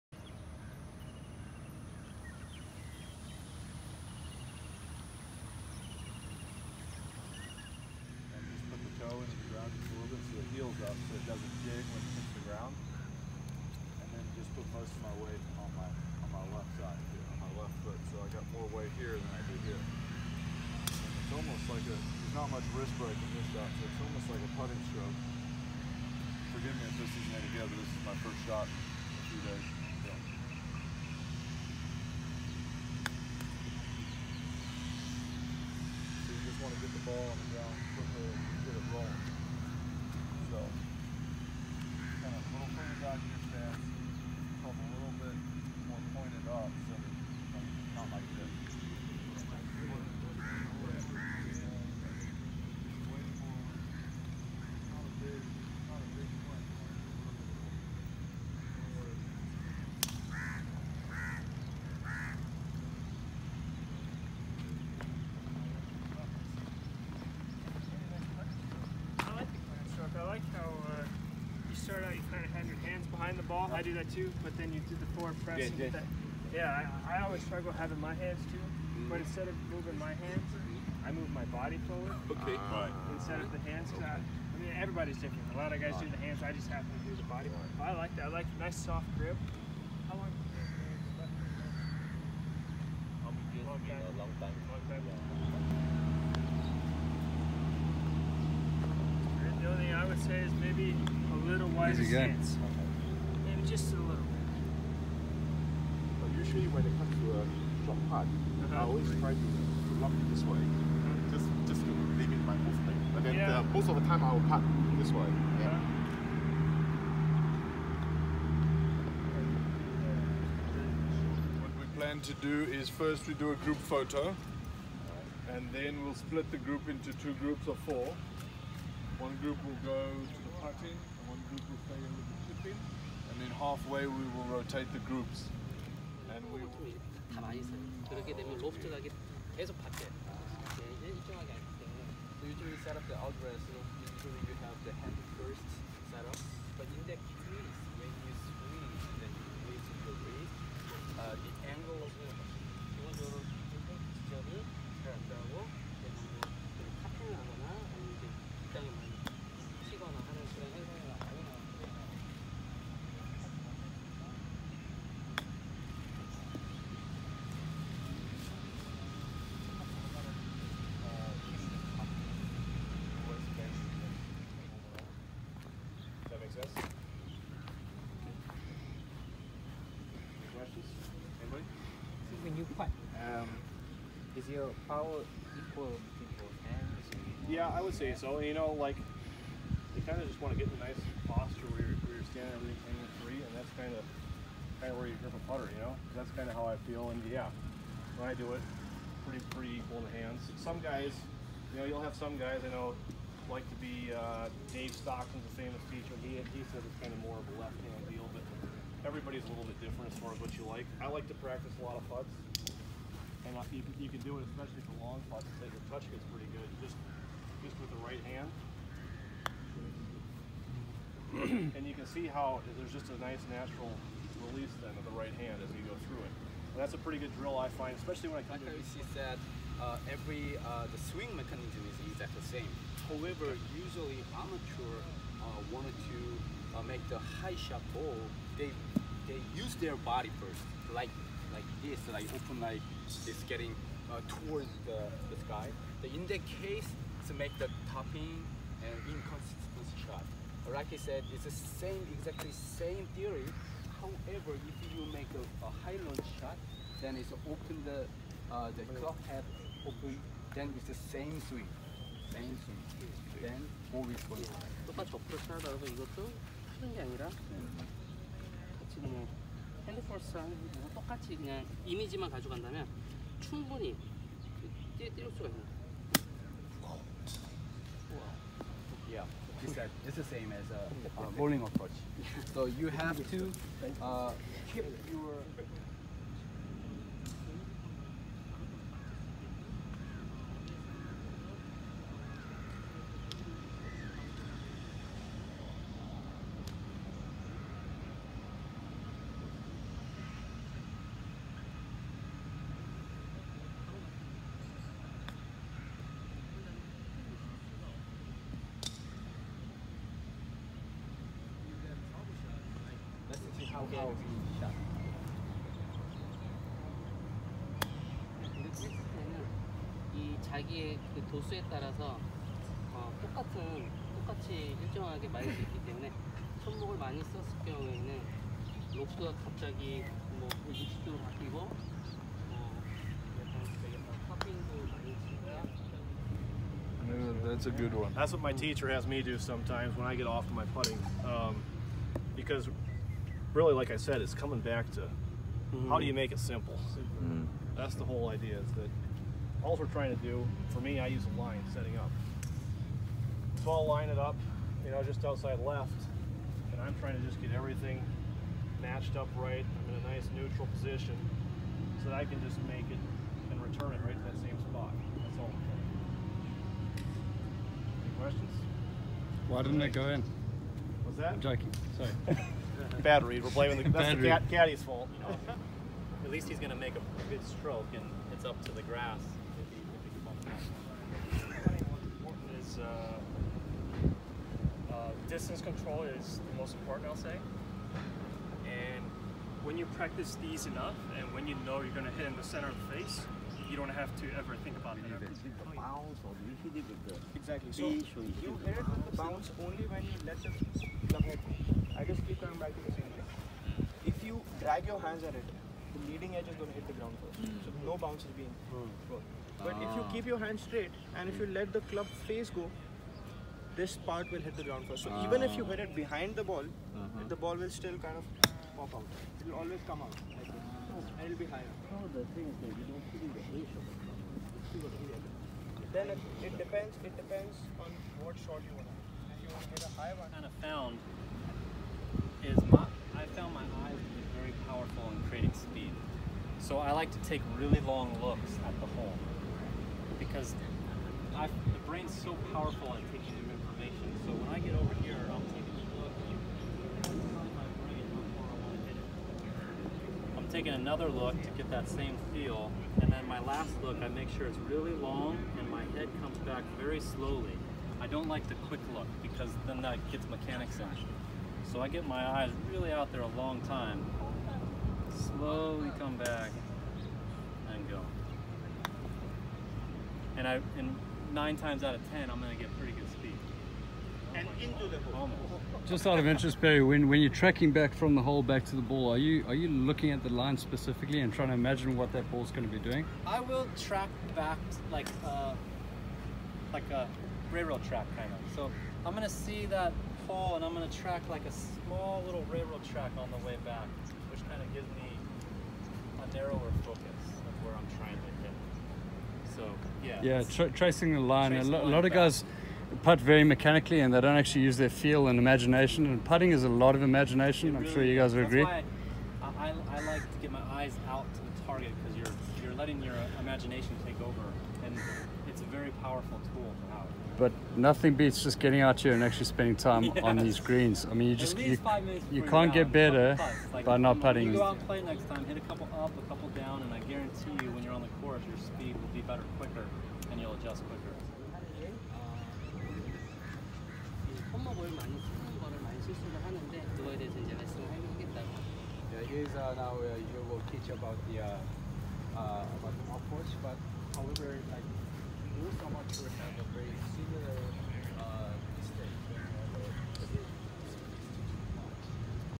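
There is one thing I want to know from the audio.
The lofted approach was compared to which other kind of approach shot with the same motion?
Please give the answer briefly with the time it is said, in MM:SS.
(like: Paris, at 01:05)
a bowling approach, at 04:41.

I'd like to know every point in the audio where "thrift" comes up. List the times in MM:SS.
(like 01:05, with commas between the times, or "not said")
not said.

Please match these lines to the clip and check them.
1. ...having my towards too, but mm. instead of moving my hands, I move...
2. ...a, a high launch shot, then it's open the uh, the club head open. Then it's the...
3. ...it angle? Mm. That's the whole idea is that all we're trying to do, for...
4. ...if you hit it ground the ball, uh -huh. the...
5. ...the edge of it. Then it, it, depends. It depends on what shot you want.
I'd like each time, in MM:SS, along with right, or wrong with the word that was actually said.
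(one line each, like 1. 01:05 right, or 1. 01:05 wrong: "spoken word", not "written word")
1. 01:17 wrong: "hands", not "towards"
2. 04:15 right
3. 05:46 wrong: "simple", not "angle"
4. 06:55 wrong: "behind", not "ground"
5. 07:03 right.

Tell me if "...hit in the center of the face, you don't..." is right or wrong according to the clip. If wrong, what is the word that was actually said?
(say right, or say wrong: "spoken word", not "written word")
right.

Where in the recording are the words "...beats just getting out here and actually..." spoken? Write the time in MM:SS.
08:38.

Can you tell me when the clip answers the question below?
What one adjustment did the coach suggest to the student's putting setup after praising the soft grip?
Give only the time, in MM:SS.
01:41.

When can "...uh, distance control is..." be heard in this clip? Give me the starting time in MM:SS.
06:24.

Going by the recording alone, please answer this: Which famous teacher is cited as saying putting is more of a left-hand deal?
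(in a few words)
Dave Stockton.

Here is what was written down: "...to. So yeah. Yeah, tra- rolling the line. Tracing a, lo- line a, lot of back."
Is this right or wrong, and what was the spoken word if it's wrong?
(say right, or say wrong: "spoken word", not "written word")
wrong: "tracing", not "rolling".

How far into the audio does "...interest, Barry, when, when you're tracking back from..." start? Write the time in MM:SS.
07:56.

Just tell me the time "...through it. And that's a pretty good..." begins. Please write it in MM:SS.
03:46.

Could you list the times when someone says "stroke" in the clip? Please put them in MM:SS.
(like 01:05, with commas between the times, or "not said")
00:24, 06:17.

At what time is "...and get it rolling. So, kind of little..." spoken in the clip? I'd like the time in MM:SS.
00:38.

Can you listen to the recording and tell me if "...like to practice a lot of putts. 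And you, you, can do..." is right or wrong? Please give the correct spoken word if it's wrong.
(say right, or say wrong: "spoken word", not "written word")
right.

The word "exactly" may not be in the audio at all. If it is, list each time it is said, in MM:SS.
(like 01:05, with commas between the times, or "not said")
03:52, 04:12, 06:37.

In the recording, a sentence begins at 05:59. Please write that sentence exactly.
I'm in a nice neutral position so that I can just make it and return it right to that same spot.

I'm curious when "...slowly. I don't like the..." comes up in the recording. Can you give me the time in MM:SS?
07:37.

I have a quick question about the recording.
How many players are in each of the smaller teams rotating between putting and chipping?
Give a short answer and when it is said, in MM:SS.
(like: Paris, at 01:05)
4, at 02:07.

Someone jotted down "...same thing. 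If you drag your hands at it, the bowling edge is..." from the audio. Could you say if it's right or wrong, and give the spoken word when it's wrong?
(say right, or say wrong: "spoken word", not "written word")
wrong: "leading", not "bowling".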